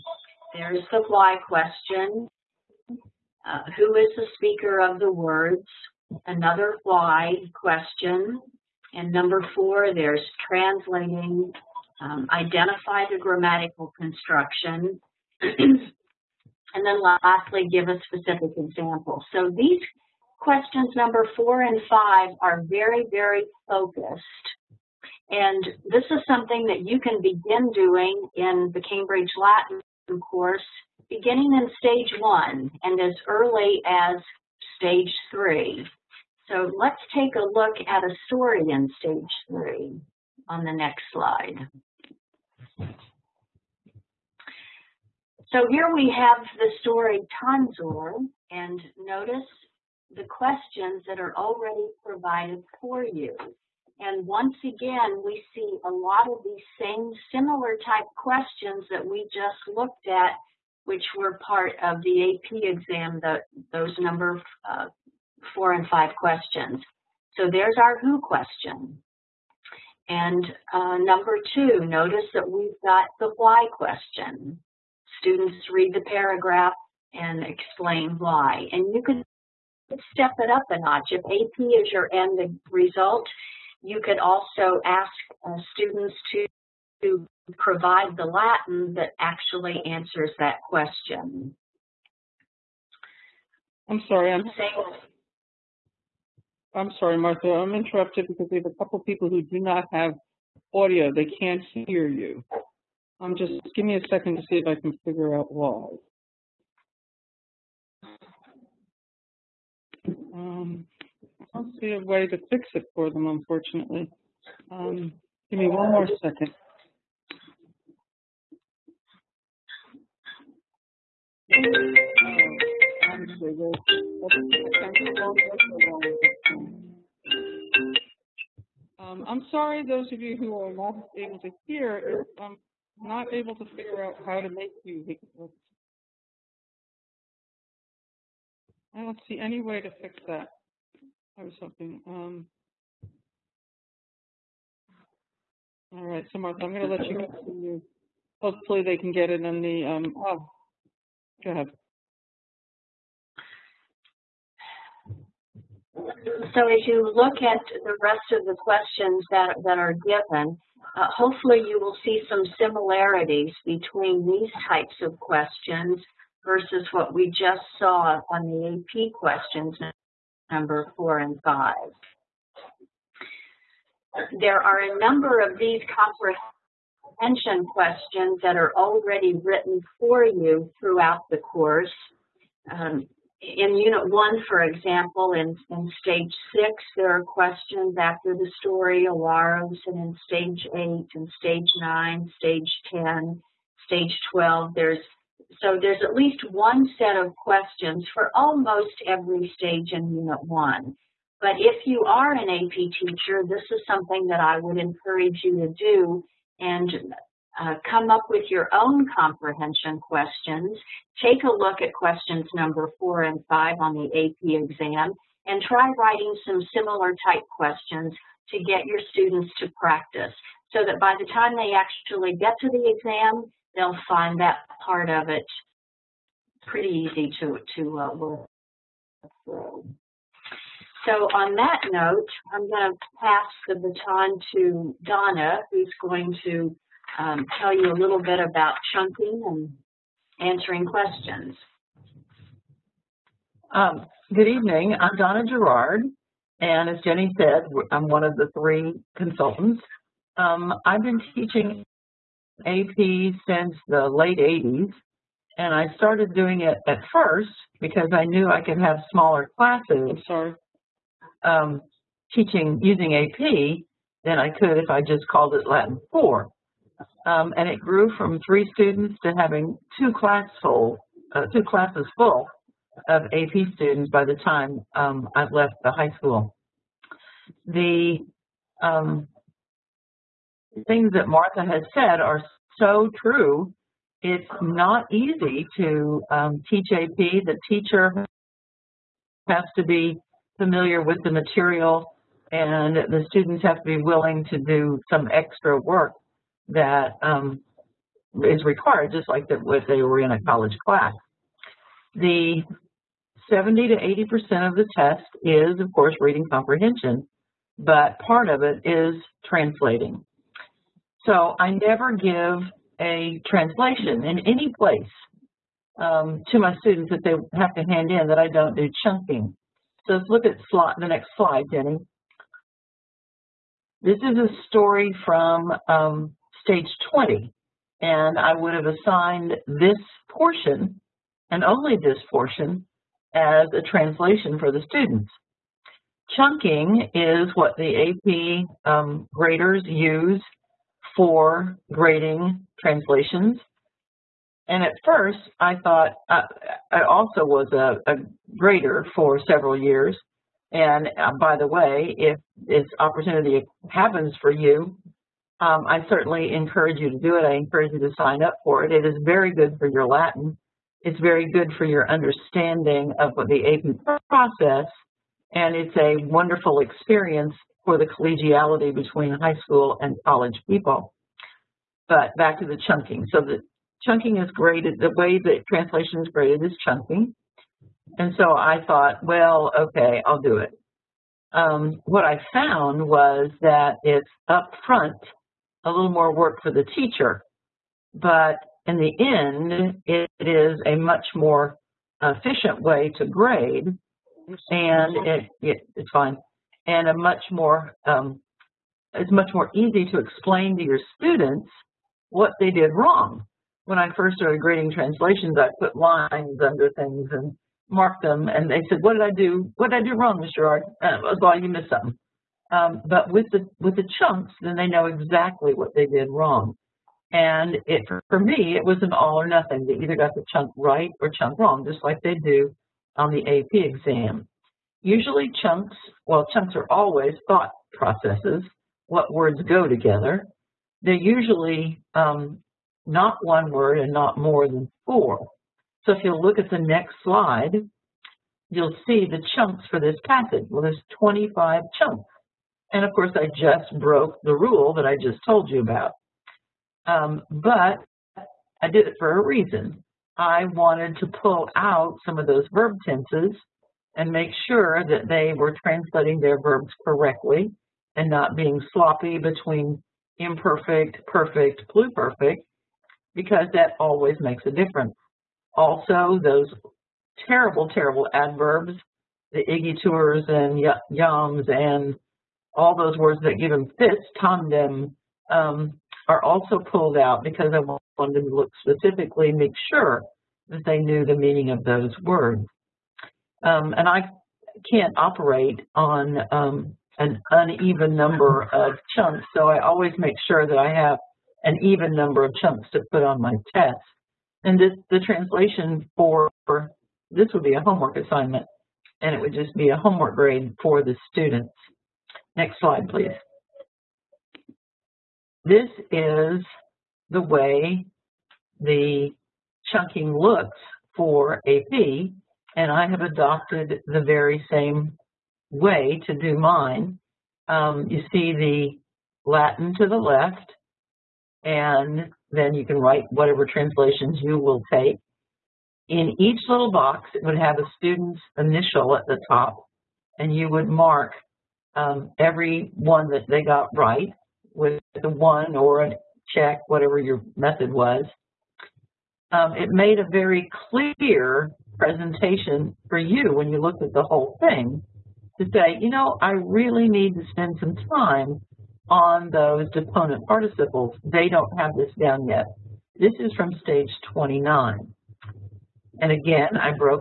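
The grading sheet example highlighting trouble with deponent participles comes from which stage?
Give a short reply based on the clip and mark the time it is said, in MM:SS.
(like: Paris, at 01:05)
29, at 09:13.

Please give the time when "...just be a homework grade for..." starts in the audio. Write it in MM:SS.
08:19.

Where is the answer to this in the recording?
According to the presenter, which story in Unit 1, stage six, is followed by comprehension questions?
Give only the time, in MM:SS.
03:09.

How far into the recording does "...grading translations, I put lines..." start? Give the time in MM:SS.
06:44.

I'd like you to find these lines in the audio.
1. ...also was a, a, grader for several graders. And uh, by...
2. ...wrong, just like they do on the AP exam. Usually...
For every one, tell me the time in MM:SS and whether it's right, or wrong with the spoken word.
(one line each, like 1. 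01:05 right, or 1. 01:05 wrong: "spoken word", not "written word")
1. 05:47 wrong: "years", not "graders"
2. 07:01 right.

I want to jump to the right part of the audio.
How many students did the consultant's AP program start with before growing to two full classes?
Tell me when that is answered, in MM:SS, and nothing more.
04:28.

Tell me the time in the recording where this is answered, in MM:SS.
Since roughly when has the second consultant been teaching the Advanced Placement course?
04:14.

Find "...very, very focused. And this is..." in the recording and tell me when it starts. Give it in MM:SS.
00:22.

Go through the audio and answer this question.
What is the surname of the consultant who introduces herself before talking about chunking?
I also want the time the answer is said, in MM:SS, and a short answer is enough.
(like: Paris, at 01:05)
Gerard, at 04:05.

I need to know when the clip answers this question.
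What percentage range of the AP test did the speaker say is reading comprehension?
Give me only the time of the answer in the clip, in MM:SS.
05:03.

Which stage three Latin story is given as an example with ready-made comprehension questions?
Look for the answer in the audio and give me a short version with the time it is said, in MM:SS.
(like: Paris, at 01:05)
Tonsor, at 00:47.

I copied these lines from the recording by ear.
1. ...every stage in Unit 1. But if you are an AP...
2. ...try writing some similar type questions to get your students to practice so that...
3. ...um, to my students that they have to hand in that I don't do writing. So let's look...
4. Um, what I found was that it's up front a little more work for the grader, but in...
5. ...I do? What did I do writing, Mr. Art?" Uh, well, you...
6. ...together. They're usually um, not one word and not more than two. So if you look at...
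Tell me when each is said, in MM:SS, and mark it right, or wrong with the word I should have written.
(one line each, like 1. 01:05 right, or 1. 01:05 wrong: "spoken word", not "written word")
1. 03:19 right
2. 03:35 right
3. 05:15 wrong: "chunking", not "writing"
4. 06:21 wrong: "teacher", not "grader"
5. 06:49 wrong: "wrong", not "writing"
6. 07:09 wrong: "four", not "two".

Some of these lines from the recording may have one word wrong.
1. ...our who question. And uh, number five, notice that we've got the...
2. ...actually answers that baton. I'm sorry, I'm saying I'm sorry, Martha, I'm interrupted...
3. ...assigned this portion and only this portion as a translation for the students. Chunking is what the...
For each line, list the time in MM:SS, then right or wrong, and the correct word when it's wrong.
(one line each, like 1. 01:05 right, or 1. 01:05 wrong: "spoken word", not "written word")
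1. 01:07 wrong: "two", not "five"
2. 01:29 wrong: "question", not "baton"
3. 05:28 right.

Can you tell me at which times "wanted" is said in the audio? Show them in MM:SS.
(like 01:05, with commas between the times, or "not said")
07:30, 07:58.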